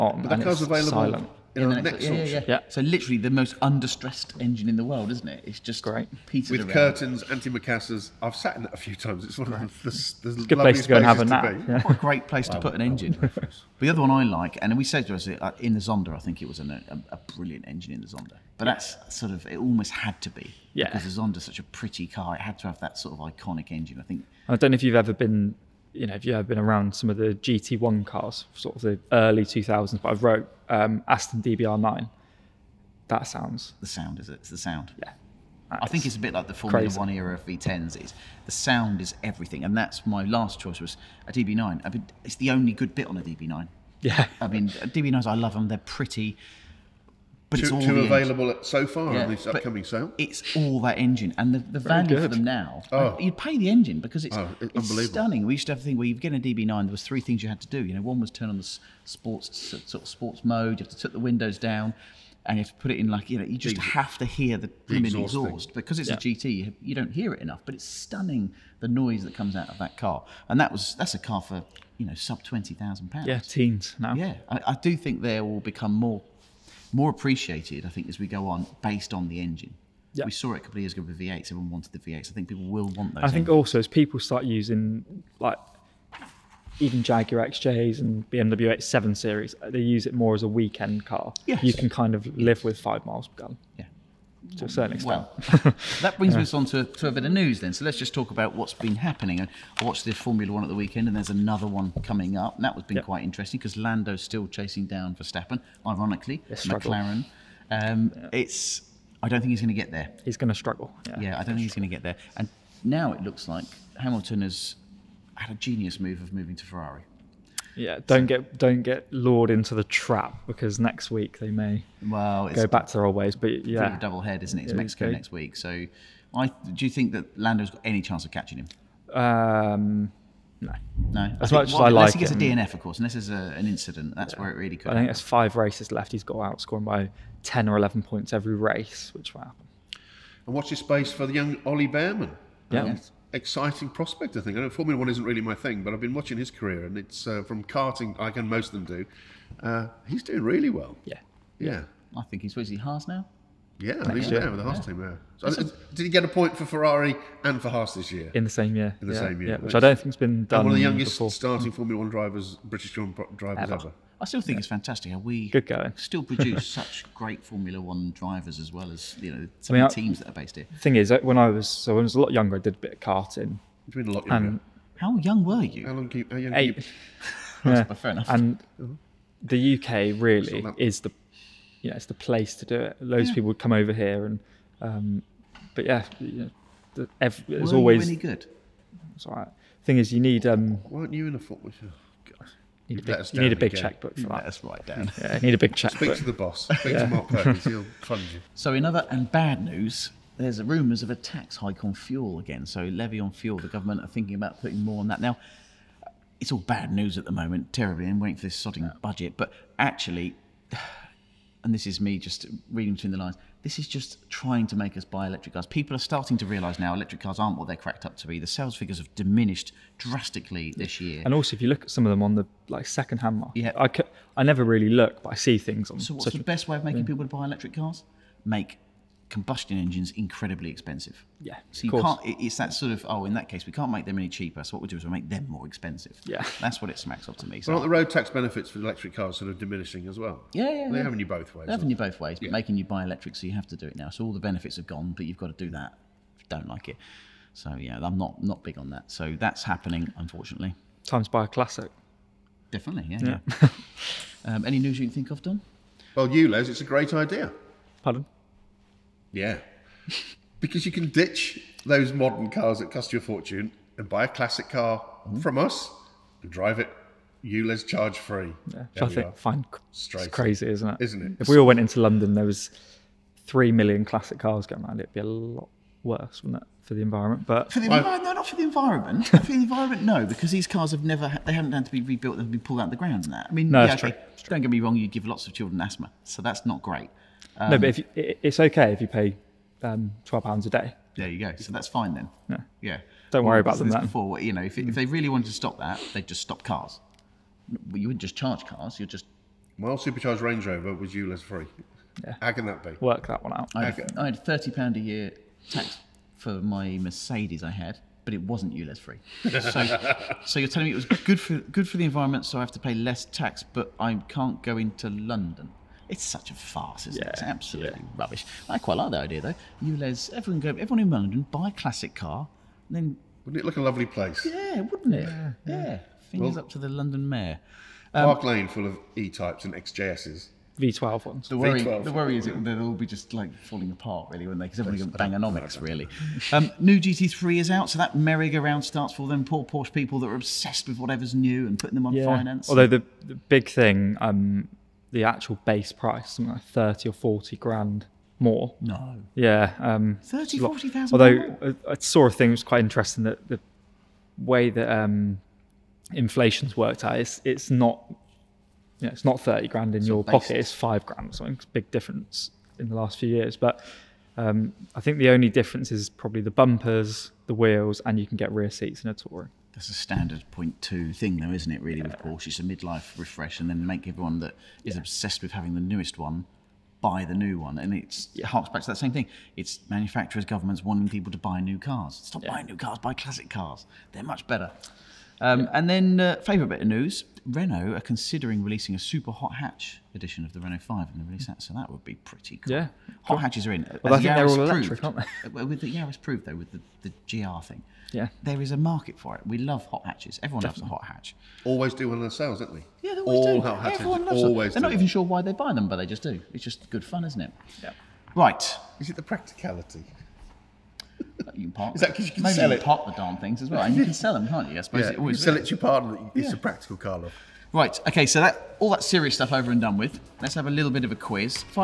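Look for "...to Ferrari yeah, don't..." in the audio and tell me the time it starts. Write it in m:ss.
1:56.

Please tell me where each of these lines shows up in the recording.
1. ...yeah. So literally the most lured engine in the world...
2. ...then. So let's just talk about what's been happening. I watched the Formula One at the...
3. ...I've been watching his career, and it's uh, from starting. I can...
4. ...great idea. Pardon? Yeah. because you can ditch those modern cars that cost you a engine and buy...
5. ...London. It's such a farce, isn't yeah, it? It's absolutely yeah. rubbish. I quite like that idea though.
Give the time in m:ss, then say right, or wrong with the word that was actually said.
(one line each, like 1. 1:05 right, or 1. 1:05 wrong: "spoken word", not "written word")
1. 0:02 wrong: "understressed", not "lured"
2. 1:37 right
3. 2:25 wrong: "karting", not "starting"
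4. 4:16 wrong: "fortune", not "engine"
5. 5:15 right.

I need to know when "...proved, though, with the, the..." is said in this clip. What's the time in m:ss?
6:36.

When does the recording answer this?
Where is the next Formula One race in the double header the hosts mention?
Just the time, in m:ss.
2:04.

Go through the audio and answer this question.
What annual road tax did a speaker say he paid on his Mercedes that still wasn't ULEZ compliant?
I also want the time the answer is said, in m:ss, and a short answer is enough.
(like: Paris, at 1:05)
30 pounds, at 5:04.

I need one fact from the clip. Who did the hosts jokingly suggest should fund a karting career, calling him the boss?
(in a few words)
Mark Perkins.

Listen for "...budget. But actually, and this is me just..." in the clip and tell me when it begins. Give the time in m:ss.
3:29.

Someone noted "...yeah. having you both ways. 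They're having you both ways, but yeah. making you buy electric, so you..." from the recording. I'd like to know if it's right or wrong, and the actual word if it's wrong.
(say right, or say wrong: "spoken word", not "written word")
right.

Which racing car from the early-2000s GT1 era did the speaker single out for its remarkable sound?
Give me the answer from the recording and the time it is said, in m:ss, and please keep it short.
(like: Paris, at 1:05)
Aston DBR9, at 0:31.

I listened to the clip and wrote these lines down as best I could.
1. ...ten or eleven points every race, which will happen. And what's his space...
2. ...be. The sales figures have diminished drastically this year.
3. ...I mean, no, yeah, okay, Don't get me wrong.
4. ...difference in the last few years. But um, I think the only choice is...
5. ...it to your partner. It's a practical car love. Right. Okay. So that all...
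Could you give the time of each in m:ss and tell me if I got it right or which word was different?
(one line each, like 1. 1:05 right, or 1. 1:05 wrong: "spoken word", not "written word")
1. 2:17 right
2. 3:38 right
3. 4:43 right
4. 6:01 wrong: "difference", not "choice"
5. 6:55 right.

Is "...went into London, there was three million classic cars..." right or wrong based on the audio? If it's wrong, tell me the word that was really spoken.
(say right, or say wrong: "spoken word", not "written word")
right.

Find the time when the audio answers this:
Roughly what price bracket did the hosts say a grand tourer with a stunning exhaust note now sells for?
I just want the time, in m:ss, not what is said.
1:12.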